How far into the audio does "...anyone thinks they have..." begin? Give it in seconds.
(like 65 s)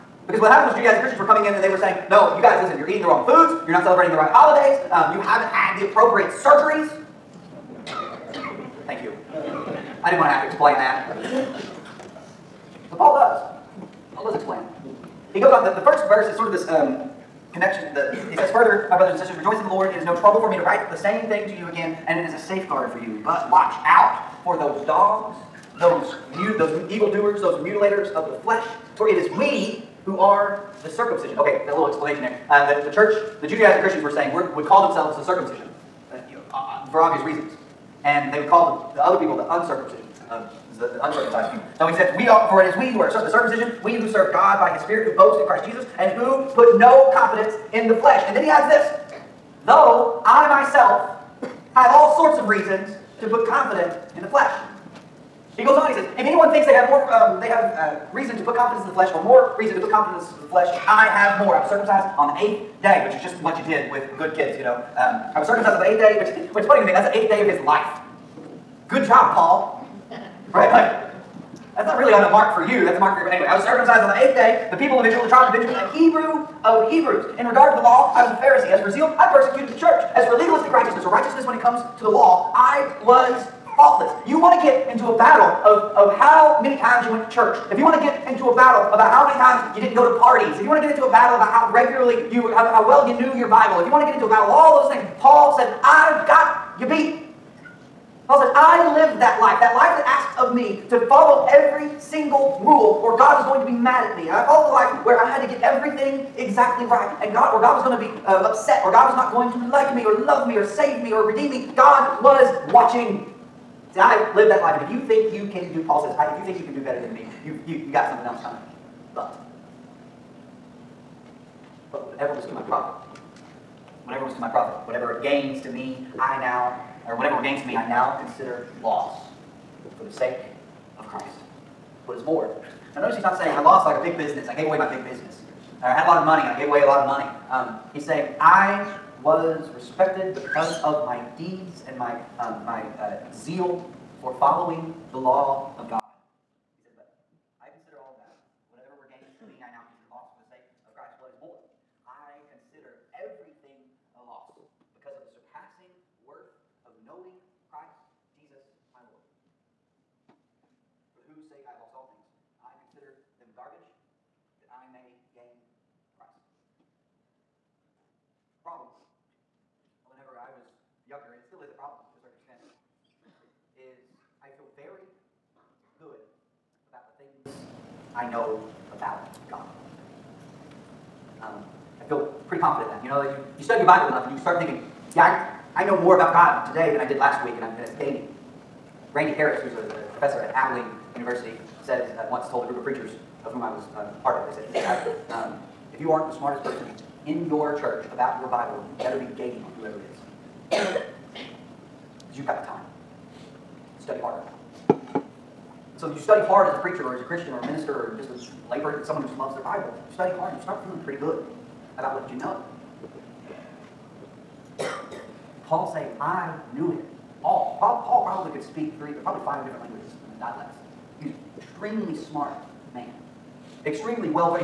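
56 s.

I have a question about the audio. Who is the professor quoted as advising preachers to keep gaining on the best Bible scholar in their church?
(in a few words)
Randy Harris.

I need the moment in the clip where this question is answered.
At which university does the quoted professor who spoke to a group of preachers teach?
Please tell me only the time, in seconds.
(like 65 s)
190 s.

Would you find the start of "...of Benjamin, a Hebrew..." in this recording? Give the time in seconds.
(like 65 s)
75 s.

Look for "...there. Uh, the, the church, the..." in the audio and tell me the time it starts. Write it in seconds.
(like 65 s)
32 s.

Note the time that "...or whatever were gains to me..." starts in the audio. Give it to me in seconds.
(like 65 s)
127 s.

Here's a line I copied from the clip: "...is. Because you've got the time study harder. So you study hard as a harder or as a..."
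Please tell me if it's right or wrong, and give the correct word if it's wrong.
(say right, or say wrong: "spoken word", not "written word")
wrong: "preacher", not "harder".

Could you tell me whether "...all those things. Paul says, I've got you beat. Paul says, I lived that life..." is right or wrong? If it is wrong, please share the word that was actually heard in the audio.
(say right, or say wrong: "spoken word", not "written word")
right.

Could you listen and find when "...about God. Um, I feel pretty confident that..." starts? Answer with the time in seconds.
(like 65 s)
178 s.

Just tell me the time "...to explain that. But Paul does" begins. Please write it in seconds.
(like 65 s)
10 s.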